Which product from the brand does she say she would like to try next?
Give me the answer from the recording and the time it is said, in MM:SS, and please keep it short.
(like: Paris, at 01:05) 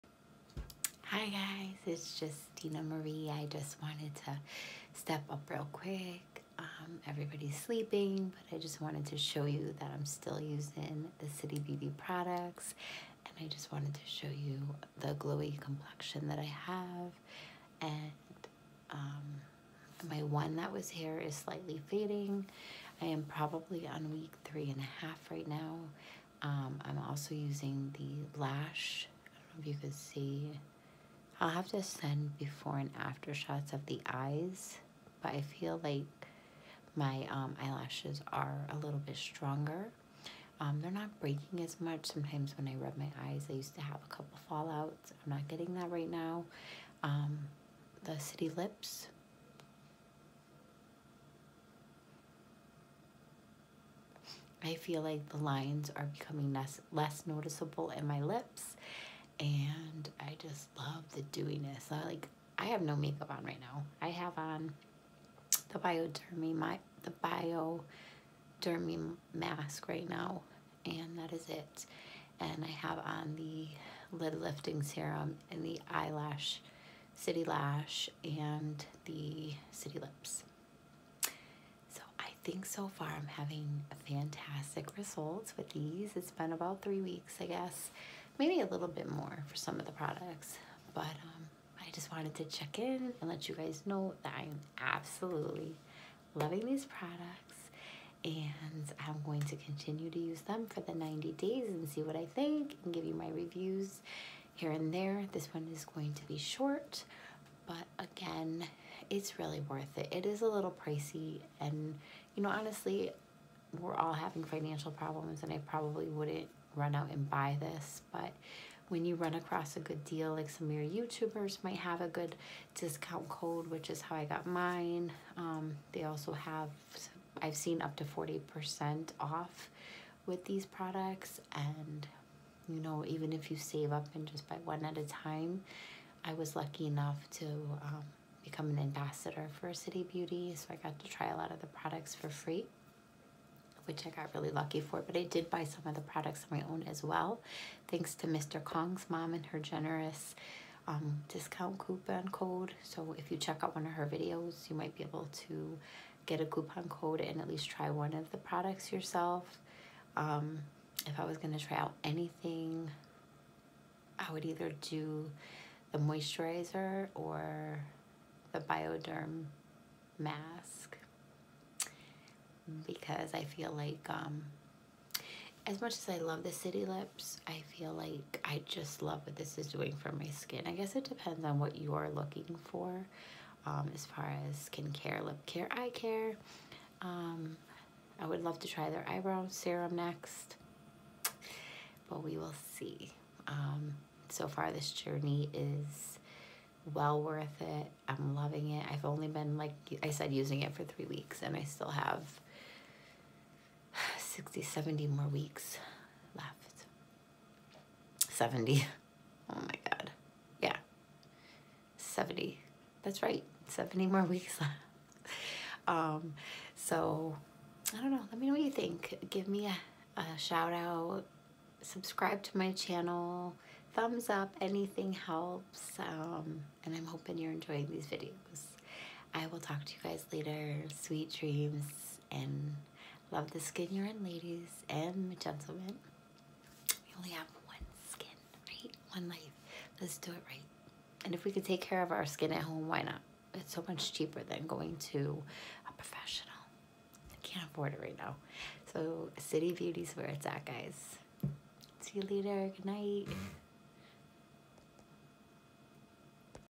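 eyebrow serum, at 03:09.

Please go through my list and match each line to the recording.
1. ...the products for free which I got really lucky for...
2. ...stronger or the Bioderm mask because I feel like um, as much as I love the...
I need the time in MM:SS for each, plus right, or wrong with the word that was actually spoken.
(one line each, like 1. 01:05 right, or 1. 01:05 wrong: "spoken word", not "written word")
1. 02:21 right
2. 02:45 wrong: "moisturizer", not "stronger".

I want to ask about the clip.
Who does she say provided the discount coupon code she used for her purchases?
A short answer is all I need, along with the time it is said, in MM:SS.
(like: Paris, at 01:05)
Mr. Kong, at 02:28.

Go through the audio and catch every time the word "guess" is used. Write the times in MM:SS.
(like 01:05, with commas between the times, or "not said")
01:27, 03:00.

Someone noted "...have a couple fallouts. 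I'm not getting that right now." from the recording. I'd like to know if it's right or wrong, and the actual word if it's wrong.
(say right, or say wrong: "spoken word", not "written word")
right.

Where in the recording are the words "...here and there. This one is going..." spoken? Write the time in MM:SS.
01:44.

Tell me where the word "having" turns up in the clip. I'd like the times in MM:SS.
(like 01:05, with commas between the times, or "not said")
01:23, 01:54.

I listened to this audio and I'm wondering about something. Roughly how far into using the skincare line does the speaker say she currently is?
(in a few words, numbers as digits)
week three and a half.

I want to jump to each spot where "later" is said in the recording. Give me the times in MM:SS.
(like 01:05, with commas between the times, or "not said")
03:50, 04:12.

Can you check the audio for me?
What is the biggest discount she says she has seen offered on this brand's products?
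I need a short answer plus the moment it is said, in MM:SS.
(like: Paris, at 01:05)
40%, at 02:08.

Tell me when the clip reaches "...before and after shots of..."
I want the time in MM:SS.
00:32.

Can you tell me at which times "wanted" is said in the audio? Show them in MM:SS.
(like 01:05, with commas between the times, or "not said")
00:03, 00:08, 00:13, 01:32.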